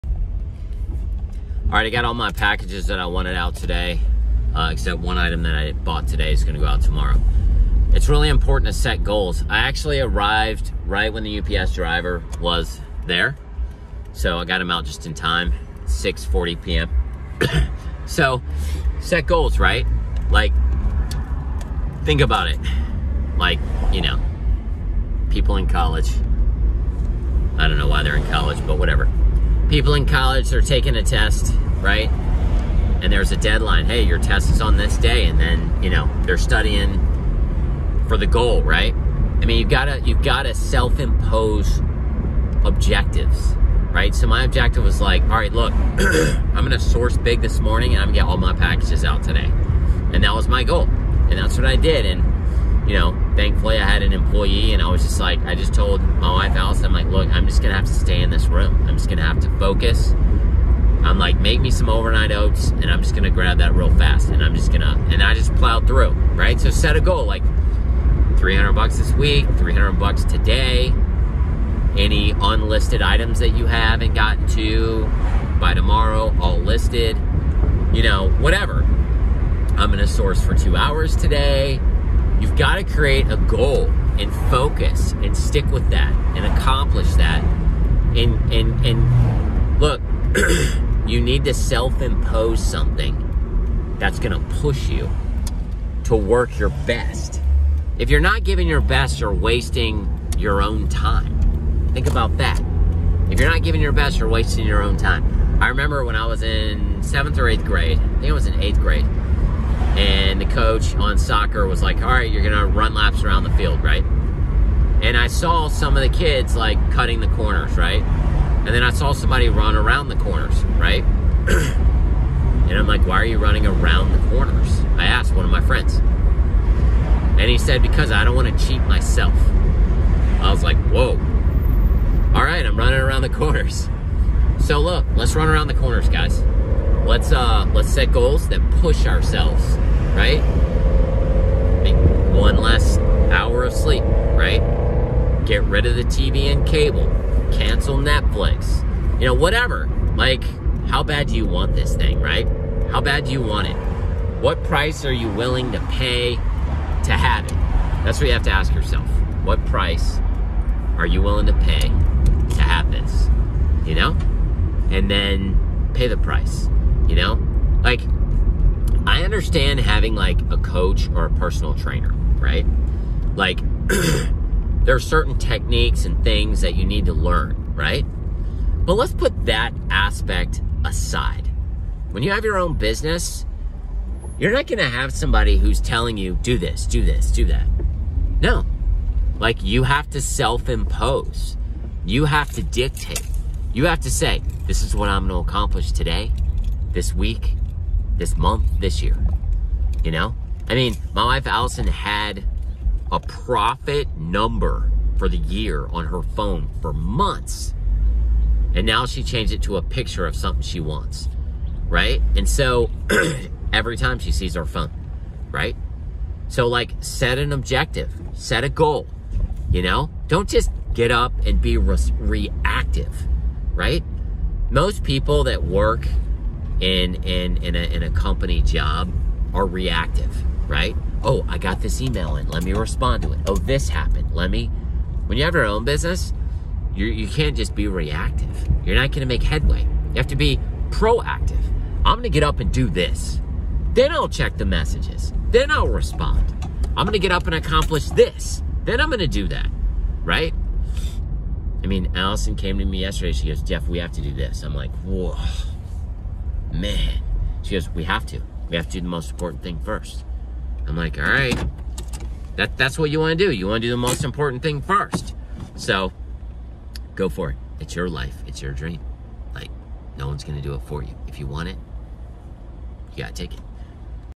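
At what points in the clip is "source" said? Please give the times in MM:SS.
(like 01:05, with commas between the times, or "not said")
00:46, 01:20.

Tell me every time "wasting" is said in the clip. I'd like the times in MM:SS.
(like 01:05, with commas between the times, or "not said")
01:39, 01:44.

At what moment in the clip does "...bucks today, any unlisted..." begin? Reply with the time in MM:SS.
01:09.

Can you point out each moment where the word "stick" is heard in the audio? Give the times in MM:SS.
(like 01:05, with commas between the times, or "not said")
01:25.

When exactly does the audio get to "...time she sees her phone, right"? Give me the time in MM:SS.
03:33.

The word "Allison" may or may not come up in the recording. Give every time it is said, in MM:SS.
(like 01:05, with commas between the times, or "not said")
00:56, 03:21, 04:12.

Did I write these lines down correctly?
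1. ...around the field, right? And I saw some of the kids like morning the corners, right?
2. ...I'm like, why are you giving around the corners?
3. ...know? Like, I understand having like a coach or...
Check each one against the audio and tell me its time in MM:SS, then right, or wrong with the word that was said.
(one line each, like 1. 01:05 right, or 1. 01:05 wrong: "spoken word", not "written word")
1. 01:53 wrong: "cutting", not "morning"
2. 02:02 wrong: "running", not "giving"
3. 02:47 right.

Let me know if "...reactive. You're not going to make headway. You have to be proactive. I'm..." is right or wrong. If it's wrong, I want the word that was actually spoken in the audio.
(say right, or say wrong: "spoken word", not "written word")
right.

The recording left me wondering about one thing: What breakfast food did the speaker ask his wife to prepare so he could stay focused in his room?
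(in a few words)
overnight oats.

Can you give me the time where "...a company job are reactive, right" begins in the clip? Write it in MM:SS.
03:48.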